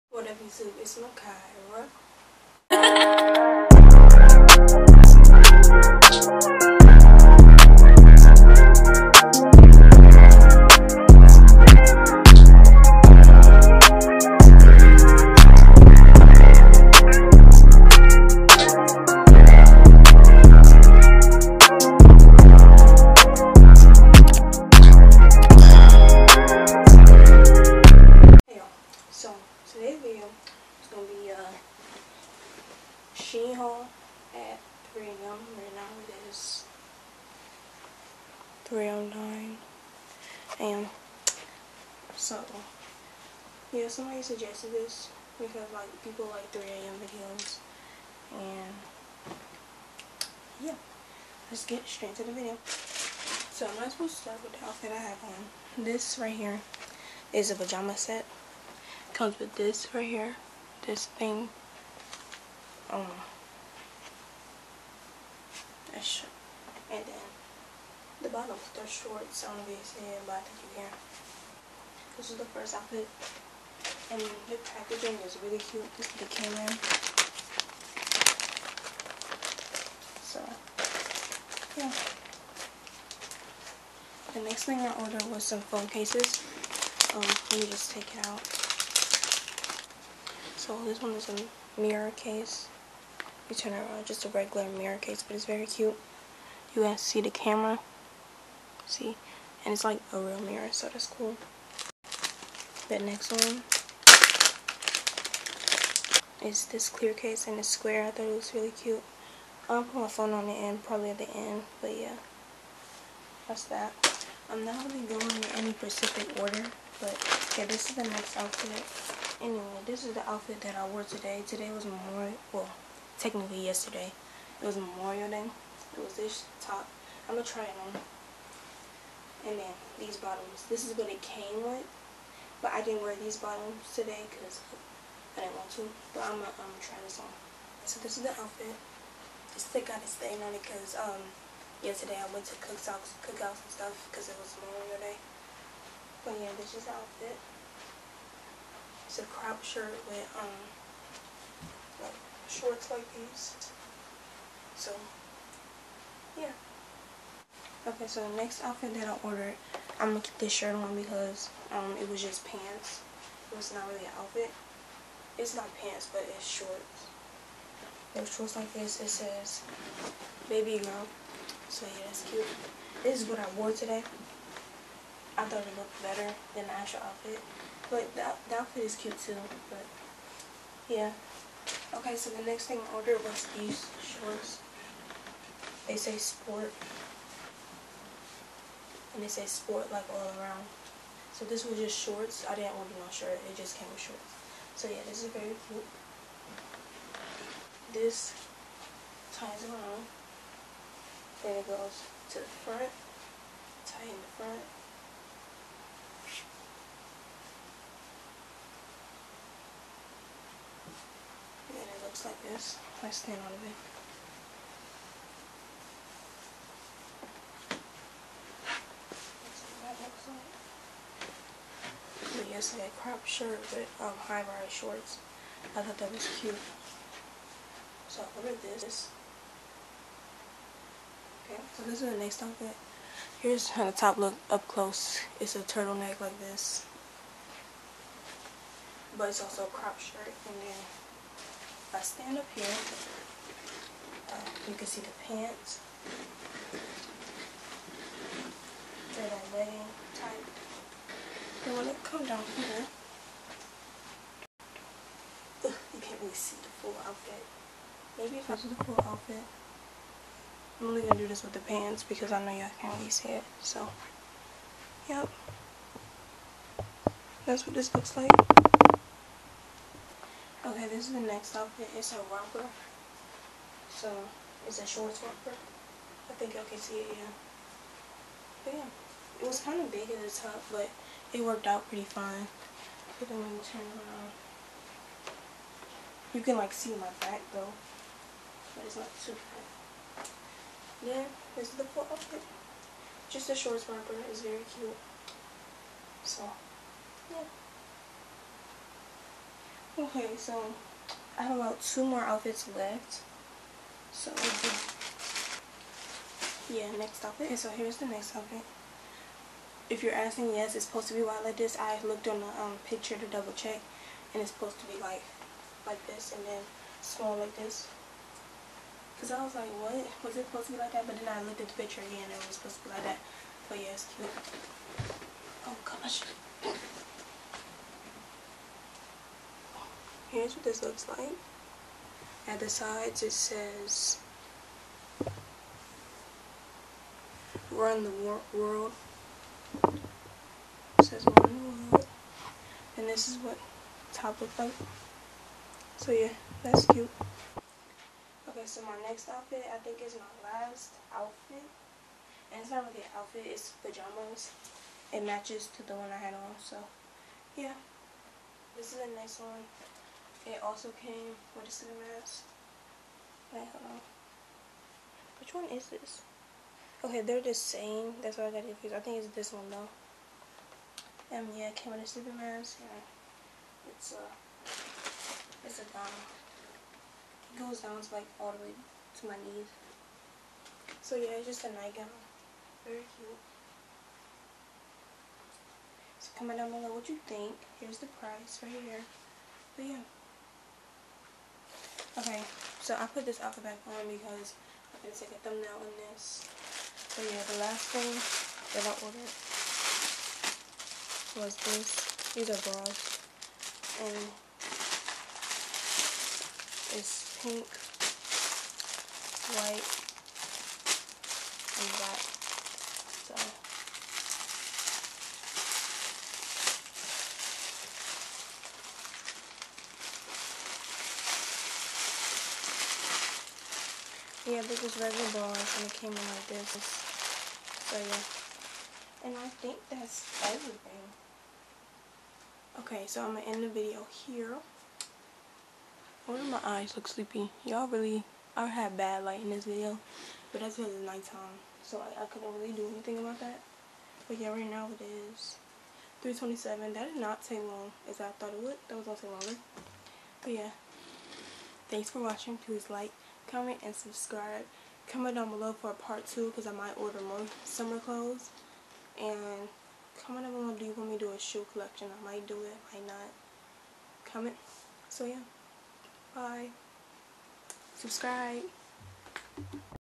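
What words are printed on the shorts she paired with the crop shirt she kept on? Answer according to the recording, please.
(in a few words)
baby girl.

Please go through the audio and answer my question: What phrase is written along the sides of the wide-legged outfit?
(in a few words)
run the world.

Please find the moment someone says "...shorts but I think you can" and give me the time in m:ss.
1:08.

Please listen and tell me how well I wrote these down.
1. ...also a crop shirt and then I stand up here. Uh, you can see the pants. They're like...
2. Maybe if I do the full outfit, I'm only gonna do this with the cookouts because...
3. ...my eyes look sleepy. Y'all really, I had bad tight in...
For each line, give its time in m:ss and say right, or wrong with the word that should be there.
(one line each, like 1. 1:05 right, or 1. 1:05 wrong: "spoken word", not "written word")
1. 3:59 right
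2. 4:18 wrong: "pants", not "cookouts"
3. 7:16 wrong: "light", not "tight".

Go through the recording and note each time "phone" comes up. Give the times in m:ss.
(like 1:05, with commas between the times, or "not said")
1:25, 1:50.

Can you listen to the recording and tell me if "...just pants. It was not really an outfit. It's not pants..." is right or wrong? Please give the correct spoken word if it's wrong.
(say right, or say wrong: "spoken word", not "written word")
right.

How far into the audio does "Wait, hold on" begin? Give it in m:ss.
6:03.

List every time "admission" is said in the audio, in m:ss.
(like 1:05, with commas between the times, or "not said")
not said.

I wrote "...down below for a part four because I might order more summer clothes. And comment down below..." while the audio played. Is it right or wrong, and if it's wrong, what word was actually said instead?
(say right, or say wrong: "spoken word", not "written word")
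wrong: "two", not "four".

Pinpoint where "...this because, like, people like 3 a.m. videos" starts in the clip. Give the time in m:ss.
0:44.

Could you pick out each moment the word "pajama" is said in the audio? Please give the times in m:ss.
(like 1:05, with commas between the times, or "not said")
0:57, 5:53.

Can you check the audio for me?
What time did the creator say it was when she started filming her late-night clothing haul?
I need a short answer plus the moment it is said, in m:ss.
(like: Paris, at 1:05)
3:09 a.m., at 0:38.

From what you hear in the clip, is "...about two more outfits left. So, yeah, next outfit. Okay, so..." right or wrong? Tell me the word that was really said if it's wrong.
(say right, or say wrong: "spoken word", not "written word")
right.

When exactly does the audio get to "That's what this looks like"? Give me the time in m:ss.
4:27.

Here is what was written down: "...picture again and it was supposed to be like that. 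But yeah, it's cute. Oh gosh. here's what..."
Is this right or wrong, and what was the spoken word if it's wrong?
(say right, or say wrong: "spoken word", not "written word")
right.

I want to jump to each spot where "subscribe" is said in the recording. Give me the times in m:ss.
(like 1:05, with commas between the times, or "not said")
7:33, 7:47.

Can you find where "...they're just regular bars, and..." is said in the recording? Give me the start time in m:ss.
7:04.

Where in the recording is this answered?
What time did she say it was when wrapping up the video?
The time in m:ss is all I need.
7:26.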